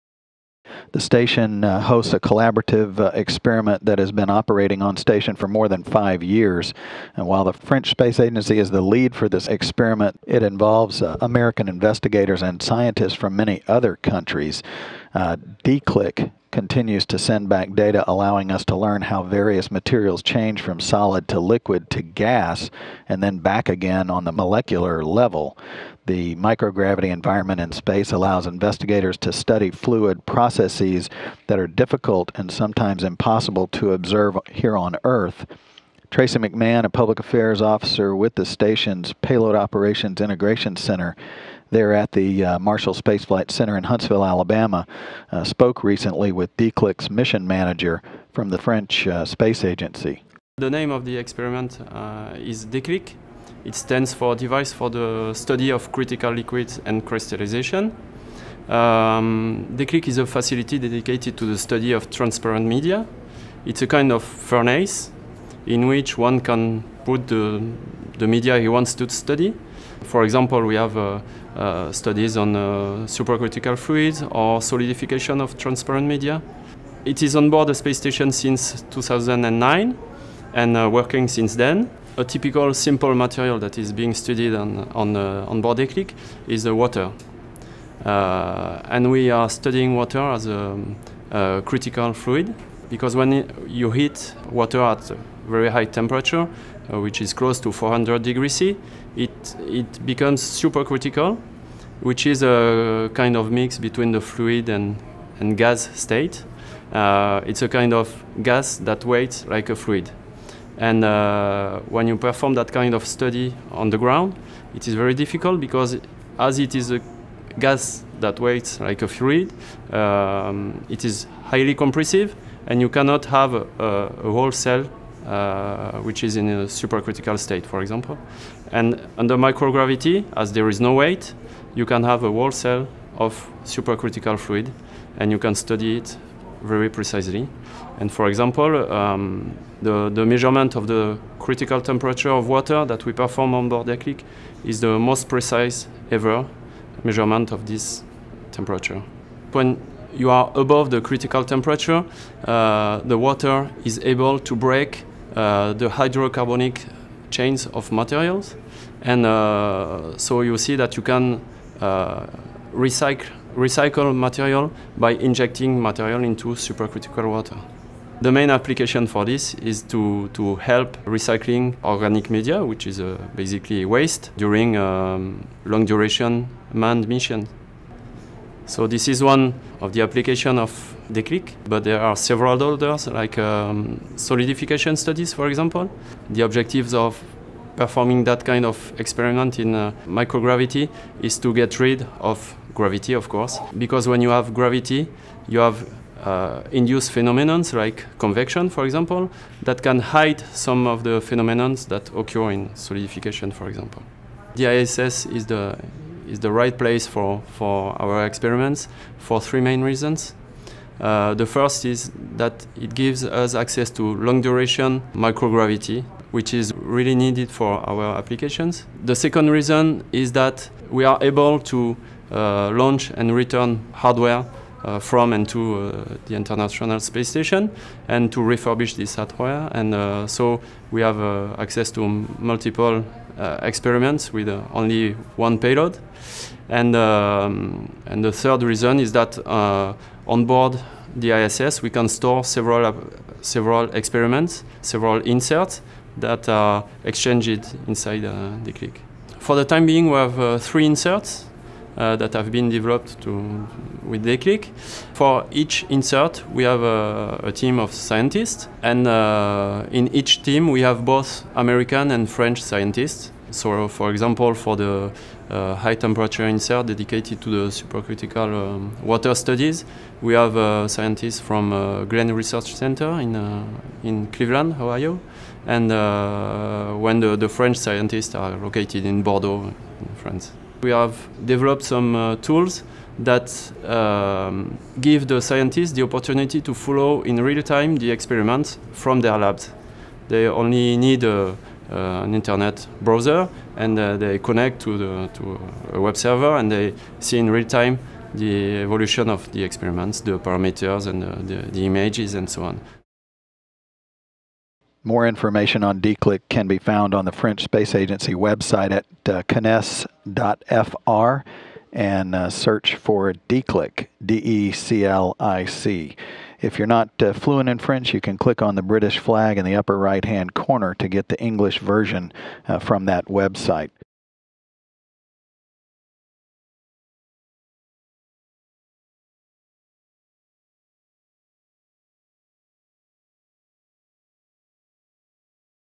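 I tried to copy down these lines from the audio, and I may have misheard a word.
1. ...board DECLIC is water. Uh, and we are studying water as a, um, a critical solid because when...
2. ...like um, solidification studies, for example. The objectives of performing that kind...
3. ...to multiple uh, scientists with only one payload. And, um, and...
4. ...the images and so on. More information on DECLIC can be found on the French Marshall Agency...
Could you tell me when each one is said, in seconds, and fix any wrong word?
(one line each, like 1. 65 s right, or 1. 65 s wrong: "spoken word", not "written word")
1. 85 s wrong: "fluid", not "solid"
2. 183 s right
3. 231 s wrong: "experiments", not "scientists"
4. 301 s wrong: "Space", not "Marshall".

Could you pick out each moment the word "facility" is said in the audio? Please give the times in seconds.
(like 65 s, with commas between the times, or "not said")
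60 s.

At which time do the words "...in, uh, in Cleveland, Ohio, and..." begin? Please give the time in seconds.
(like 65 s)
273 s.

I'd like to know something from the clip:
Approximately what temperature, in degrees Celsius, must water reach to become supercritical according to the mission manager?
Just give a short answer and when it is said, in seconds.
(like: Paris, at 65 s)
400 degrees C, at 97 s.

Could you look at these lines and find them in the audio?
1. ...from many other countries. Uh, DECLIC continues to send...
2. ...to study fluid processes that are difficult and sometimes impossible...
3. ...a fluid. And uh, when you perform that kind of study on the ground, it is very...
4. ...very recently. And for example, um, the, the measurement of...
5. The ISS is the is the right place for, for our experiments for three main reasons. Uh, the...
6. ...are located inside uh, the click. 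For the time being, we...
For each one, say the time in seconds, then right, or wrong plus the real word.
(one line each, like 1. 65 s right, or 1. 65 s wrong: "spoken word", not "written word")
1. 13 s right
2. 29 s right
3. 109 s right
4. 136 s wrong: "precisely", not "recently"
5. 204 s right
6. 246 s wrong: "exchanged", not "located".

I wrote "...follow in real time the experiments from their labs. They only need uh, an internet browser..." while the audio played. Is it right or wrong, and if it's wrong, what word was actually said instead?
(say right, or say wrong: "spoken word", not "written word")
right.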